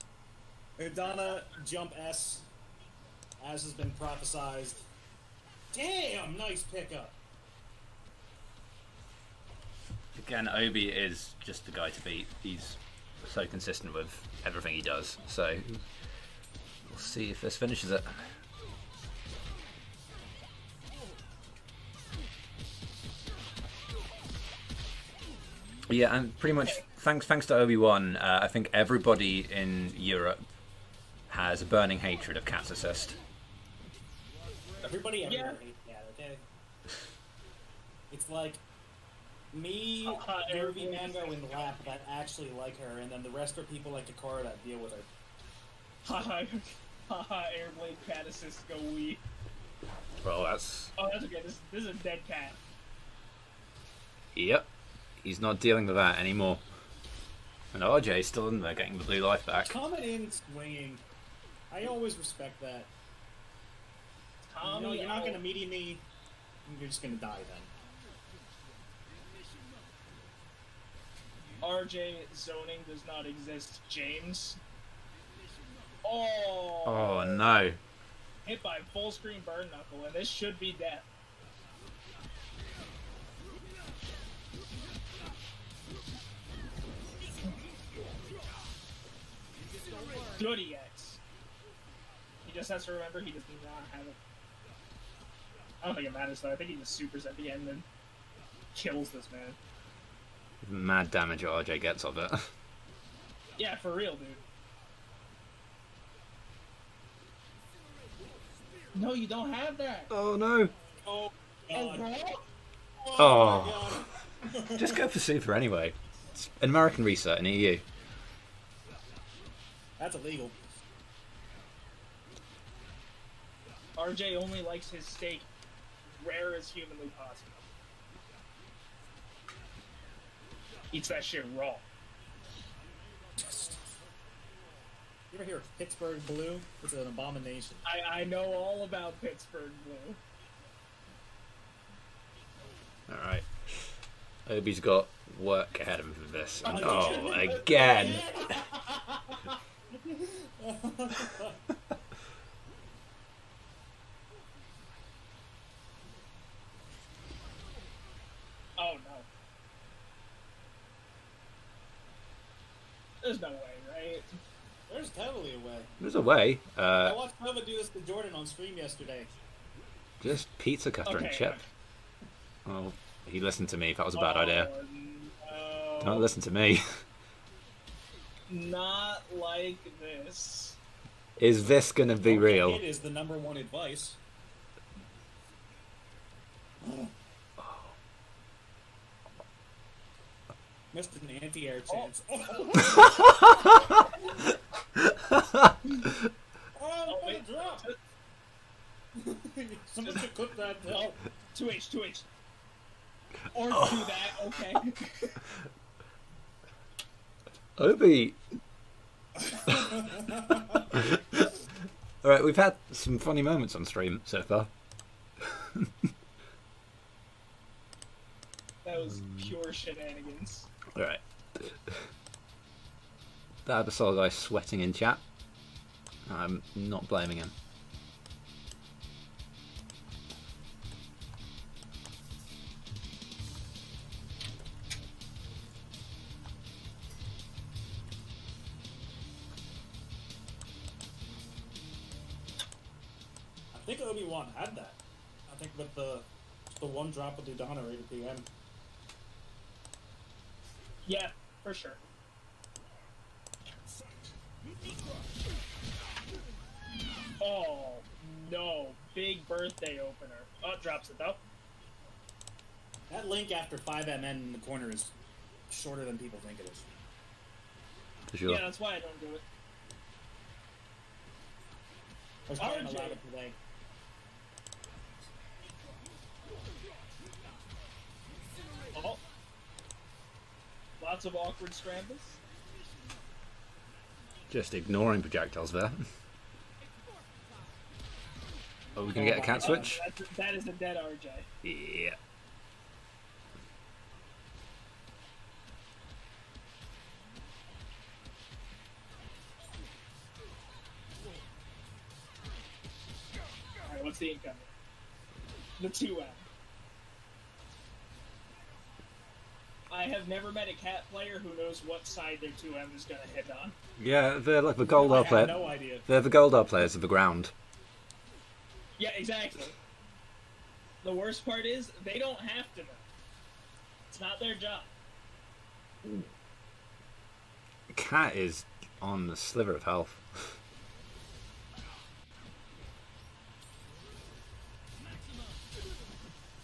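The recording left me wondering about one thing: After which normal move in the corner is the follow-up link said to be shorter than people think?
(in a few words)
5MN.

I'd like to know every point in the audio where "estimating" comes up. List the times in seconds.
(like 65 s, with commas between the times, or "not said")
not said.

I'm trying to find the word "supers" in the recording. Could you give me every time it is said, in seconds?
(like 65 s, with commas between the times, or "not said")
96 s, 115 s.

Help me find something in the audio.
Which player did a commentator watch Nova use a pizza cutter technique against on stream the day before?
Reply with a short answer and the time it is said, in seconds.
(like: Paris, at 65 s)
Jordan, at 168 s.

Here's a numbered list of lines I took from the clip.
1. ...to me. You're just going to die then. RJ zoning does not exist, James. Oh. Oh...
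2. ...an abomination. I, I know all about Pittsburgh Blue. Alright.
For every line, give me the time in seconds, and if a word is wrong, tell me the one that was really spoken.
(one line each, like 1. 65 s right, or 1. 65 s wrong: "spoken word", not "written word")
1. 65 s right
2. 136 s right.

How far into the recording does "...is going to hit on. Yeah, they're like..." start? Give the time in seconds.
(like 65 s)
312 s.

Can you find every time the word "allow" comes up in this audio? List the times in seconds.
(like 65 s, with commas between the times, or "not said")
272 s.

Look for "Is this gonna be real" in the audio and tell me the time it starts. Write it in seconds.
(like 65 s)
181 s.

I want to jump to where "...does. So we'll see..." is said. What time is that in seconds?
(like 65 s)
14 s.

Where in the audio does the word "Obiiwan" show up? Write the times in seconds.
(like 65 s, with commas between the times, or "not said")
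27 s, 244 s.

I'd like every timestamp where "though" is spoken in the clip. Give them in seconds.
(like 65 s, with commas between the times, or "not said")
96 s, 261 s.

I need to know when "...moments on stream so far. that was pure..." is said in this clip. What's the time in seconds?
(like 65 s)
213 s.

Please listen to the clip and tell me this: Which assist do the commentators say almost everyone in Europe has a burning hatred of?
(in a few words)
Cat assist.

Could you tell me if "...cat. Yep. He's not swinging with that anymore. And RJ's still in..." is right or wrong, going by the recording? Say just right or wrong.
wrong.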